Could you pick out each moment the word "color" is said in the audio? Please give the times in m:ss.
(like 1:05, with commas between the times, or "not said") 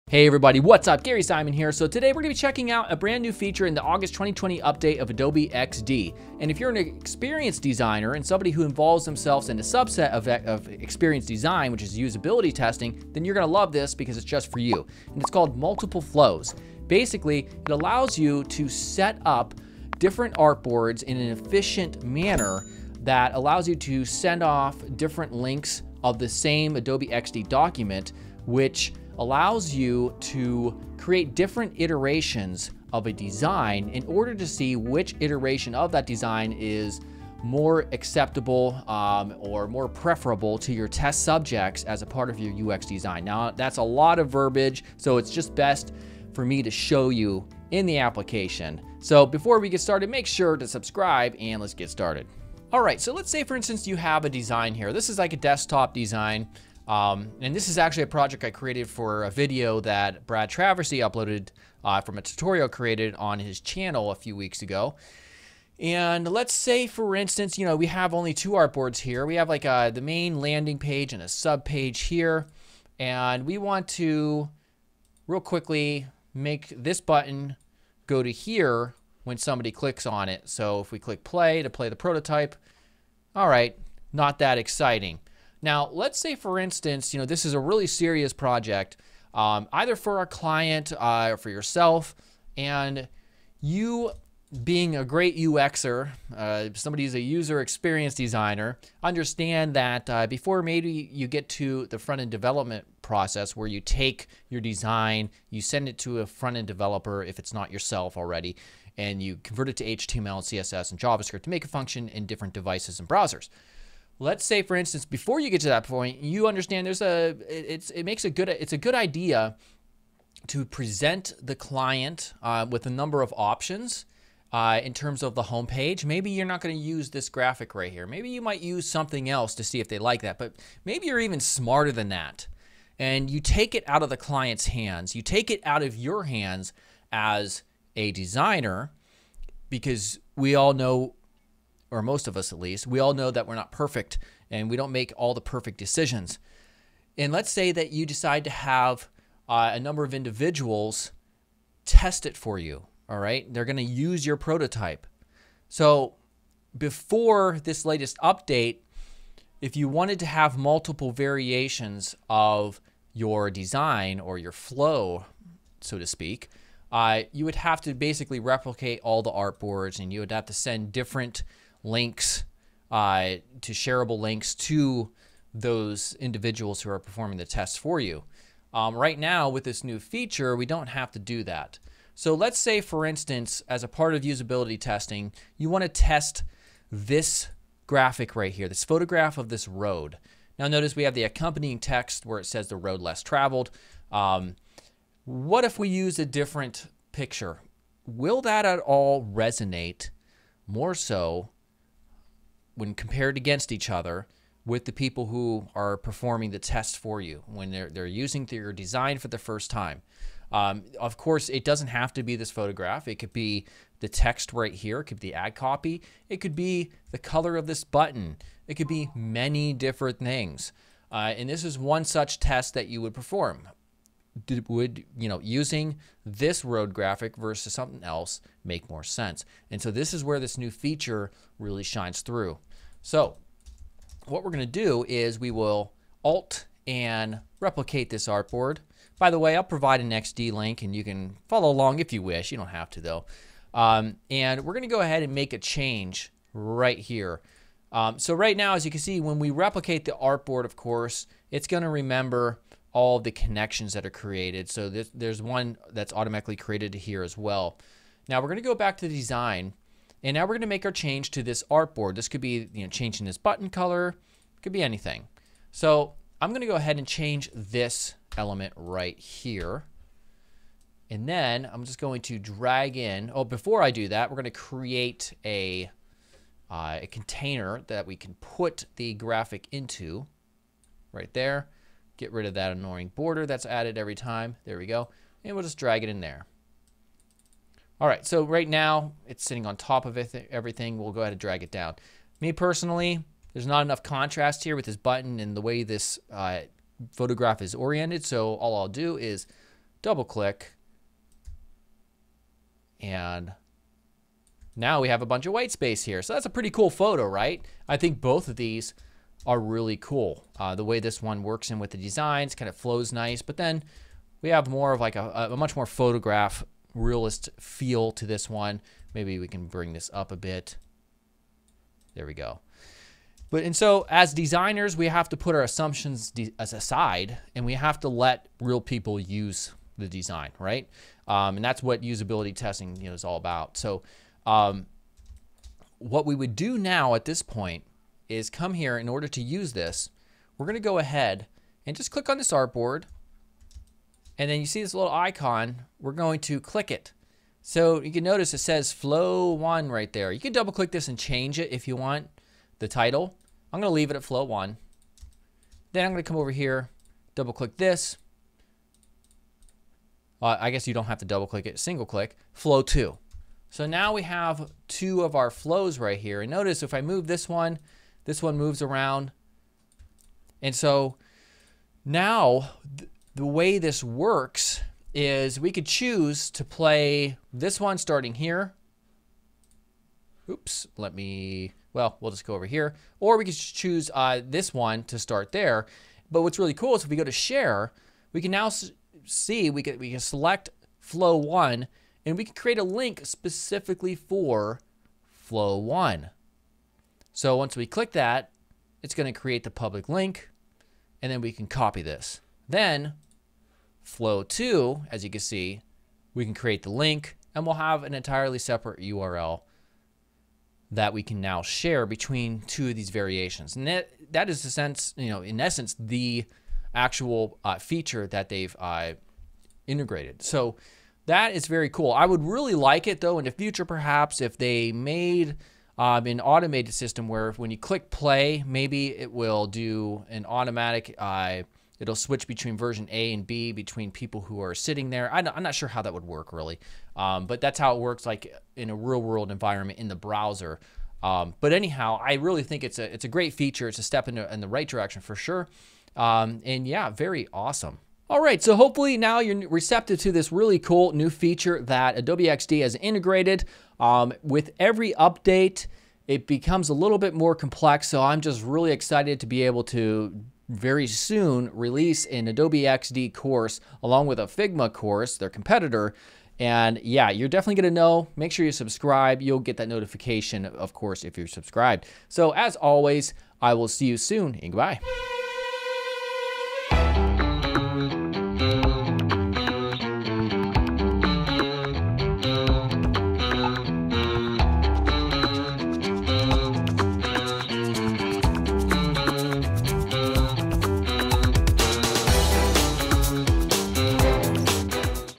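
3:37, 4:23.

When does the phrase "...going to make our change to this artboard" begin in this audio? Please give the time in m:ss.
4:20.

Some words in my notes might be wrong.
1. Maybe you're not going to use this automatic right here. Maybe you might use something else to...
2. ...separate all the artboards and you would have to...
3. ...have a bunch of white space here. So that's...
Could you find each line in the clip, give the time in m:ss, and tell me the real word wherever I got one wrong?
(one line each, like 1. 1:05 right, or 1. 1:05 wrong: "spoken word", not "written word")
1. 2:06 wrong: "graphic", not "automatic"
2. 2:48 wrong: "replicate", not "separate"
3. 5:05 right.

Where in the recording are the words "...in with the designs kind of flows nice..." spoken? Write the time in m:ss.
5:11.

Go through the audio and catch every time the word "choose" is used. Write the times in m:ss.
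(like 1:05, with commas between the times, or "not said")
6:15, 6:23.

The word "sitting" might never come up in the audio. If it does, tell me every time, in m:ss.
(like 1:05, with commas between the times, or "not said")
4:49, 7:14.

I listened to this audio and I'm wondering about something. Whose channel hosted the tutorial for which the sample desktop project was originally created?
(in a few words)
Brad Traversy.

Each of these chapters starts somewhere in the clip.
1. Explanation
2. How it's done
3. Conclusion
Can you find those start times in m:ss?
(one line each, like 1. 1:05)
1. 0:52
2. 3:53
3. 7:28.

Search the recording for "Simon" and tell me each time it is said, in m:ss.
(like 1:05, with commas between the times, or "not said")
0:01.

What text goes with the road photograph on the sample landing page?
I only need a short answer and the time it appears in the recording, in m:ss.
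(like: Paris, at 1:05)
the road less traveled, at 3:12.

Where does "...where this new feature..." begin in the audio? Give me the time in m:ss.
3:50.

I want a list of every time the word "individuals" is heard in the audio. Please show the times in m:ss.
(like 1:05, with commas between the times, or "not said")
2:30, 2:56.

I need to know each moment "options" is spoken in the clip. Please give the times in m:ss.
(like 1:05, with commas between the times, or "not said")
2:03.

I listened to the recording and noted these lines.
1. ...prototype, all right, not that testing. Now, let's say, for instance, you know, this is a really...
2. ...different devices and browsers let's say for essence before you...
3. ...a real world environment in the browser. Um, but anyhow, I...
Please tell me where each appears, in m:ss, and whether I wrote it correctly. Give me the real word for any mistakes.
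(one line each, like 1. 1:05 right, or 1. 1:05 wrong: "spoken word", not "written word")
1. 1:21 wrong: "exciting", not "testing"
2. 1:52 wrong: "instance", not "essence"
3. 7:18 right.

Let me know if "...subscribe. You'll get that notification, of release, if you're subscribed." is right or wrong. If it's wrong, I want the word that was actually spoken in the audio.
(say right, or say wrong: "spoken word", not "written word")
wrong: "course", not "release".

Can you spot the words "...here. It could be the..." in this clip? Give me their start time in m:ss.
3:34.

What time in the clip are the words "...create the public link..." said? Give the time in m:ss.
6:39.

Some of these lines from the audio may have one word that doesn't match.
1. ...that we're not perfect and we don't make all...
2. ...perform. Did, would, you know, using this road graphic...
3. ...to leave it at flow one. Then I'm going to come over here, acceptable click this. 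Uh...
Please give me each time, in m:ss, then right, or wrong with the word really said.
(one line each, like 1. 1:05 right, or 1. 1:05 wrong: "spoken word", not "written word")
1. 2:23 right
2. 3:43 right
3. 5:53 wrong: "double", not "acceptable".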